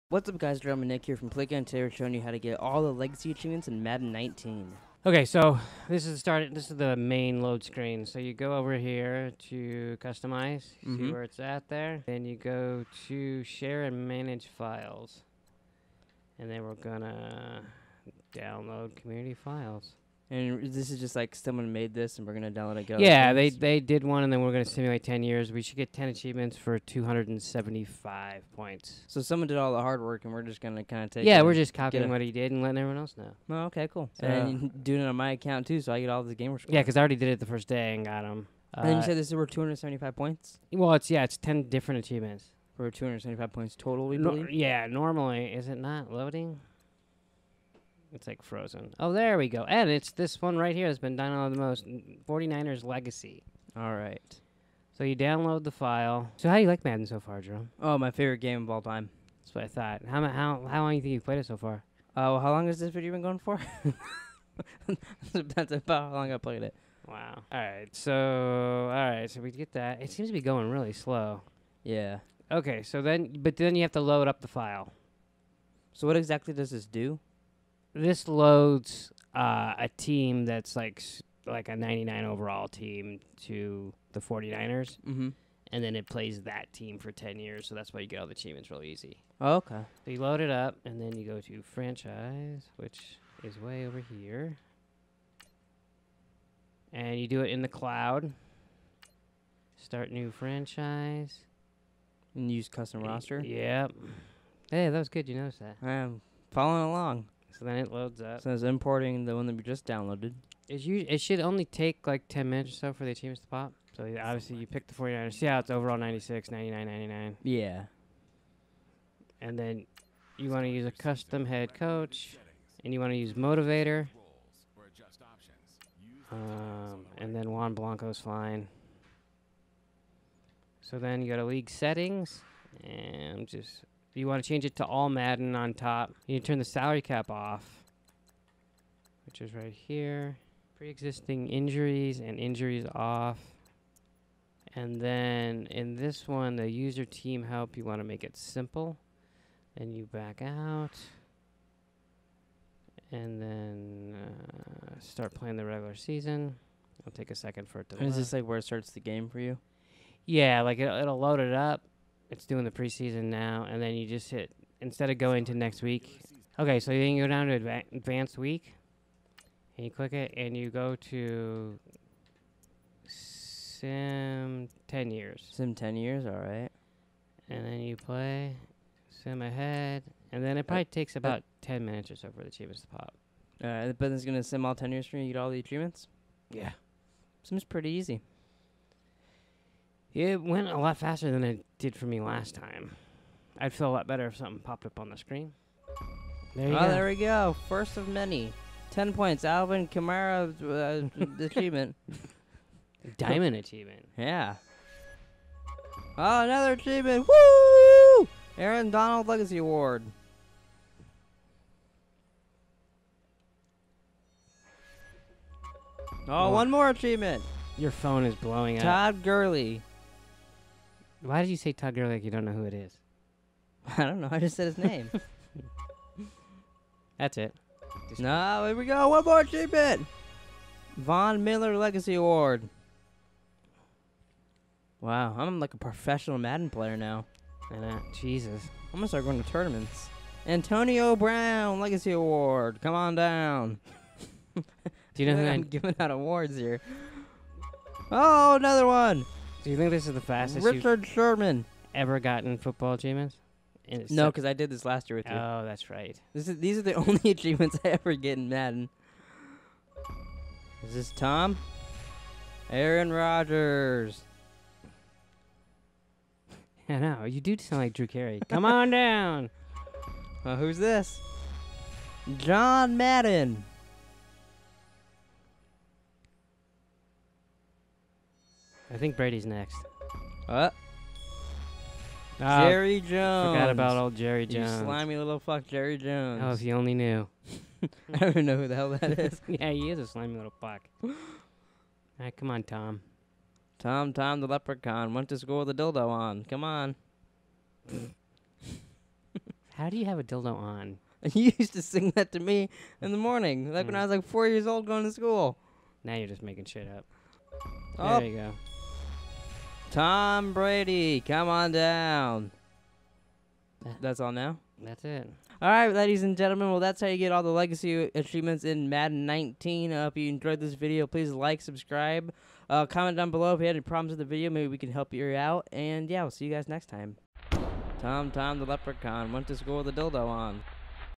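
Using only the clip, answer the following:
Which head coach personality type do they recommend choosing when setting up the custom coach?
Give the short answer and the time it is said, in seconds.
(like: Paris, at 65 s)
motivator, at 123 s.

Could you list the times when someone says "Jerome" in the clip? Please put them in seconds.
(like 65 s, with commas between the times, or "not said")
57 s.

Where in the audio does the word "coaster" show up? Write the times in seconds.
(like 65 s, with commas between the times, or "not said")
not said.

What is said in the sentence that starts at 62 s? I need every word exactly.
Oh, uh, well, how long has this video been going for?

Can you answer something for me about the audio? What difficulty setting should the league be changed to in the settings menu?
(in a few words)
All Madden.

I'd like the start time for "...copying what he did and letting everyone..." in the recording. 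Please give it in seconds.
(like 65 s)
31 s.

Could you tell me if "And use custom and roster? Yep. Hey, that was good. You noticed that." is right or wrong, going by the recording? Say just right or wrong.
right.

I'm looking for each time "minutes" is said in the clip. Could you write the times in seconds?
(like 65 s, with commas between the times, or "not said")
112 s, 181 s.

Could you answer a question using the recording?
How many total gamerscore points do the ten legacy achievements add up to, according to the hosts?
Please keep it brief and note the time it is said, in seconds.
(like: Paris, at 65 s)
275, at 26 s.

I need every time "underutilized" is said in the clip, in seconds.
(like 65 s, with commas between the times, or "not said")
not said.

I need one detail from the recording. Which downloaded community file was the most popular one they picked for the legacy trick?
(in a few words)
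49ers Legacy.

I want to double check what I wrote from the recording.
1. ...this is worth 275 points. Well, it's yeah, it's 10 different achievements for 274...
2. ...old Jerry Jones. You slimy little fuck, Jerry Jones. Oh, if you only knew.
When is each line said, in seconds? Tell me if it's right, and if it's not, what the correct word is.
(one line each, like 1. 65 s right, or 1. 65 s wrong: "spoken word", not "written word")
1. 39 s wrong: "275", not "274"
2. 283 s right.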